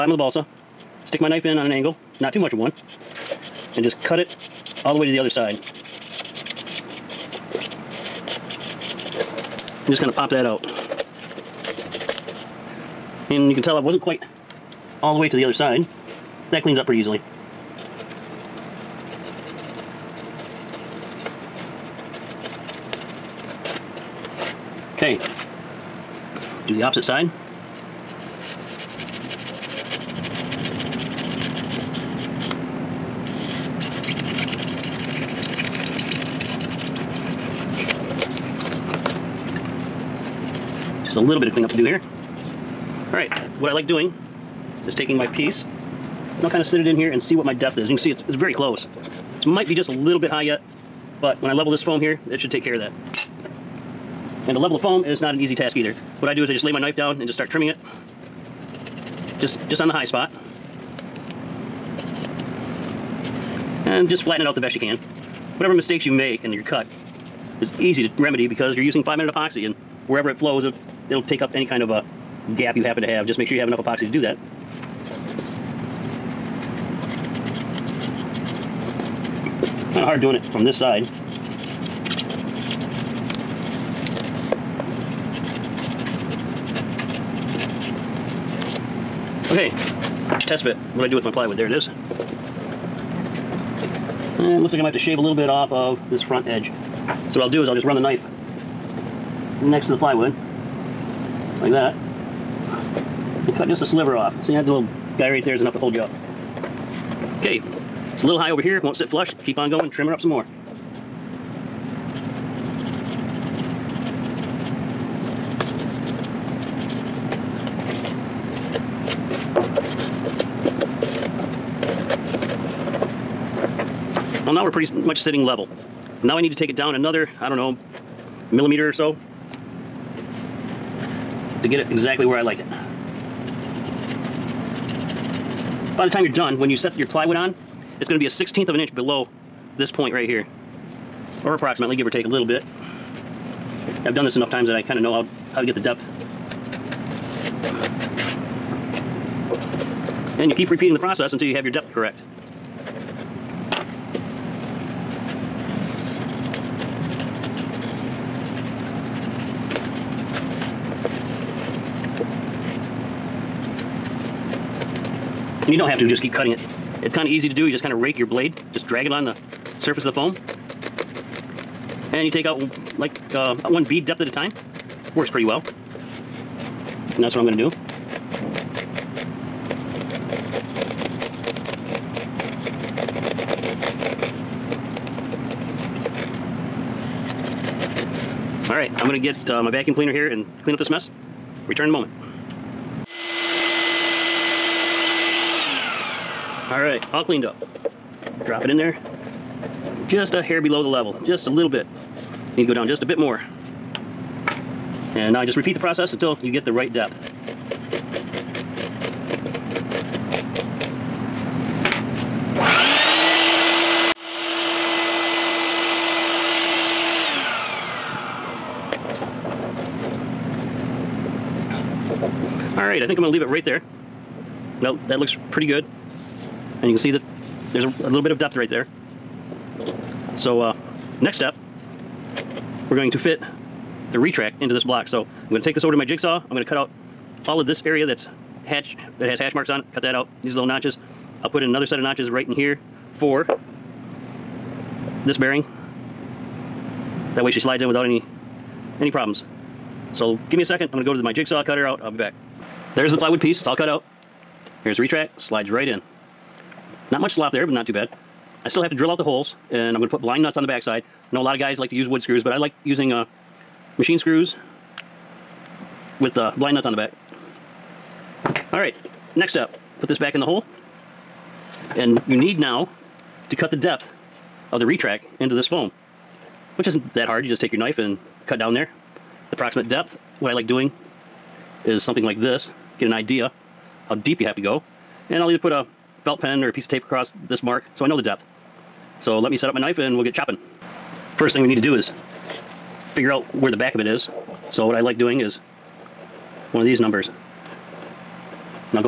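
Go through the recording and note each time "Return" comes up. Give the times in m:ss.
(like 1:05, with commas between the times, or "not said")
3:11.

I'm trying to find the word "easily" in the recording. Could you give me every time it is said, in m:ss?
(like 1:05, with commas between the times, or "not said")
0:16.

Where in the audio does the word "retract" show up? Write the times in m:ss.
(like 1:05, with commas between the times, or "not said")
3:54, 4:14, 4:34.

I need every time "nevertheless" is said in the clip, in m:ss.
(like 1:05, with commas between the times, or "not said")
not said.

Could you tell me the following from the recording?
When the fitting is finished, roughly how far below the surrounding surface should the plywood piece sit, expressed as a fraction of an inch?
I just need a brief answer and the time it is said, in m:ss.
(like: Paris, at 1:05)
1/16 of an inch, at 2:18.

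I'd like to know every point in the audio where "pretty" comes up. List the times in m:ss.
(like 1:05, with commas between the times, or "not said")
0:16, 2:04, 2:55, 3:45.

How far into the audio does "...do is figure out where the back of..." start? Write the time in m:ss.
4:51.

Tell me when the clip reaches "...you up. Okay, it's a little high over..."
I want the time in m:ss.
1:45.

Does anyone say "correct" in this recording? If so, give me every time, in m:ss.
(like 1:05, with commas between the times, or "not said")
2:31.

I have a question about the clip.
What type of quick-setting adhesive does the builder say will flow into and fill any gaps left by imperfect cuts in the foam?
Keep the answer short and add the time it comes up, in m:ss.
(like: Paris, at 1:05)
5 minute epoxy, at 1:09.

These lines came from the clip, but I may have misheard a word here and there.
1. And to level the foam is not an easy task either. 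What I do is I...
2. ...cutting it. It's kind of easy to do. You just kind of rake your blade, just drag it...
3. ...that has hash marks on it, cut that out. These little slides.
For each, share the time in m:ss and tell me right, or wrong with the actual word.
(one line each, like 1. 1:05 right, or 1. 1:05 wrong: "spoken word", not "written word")
1. 0:54 right
2. 2:46 right
3. 3:59 wrong: "notches", not "slides".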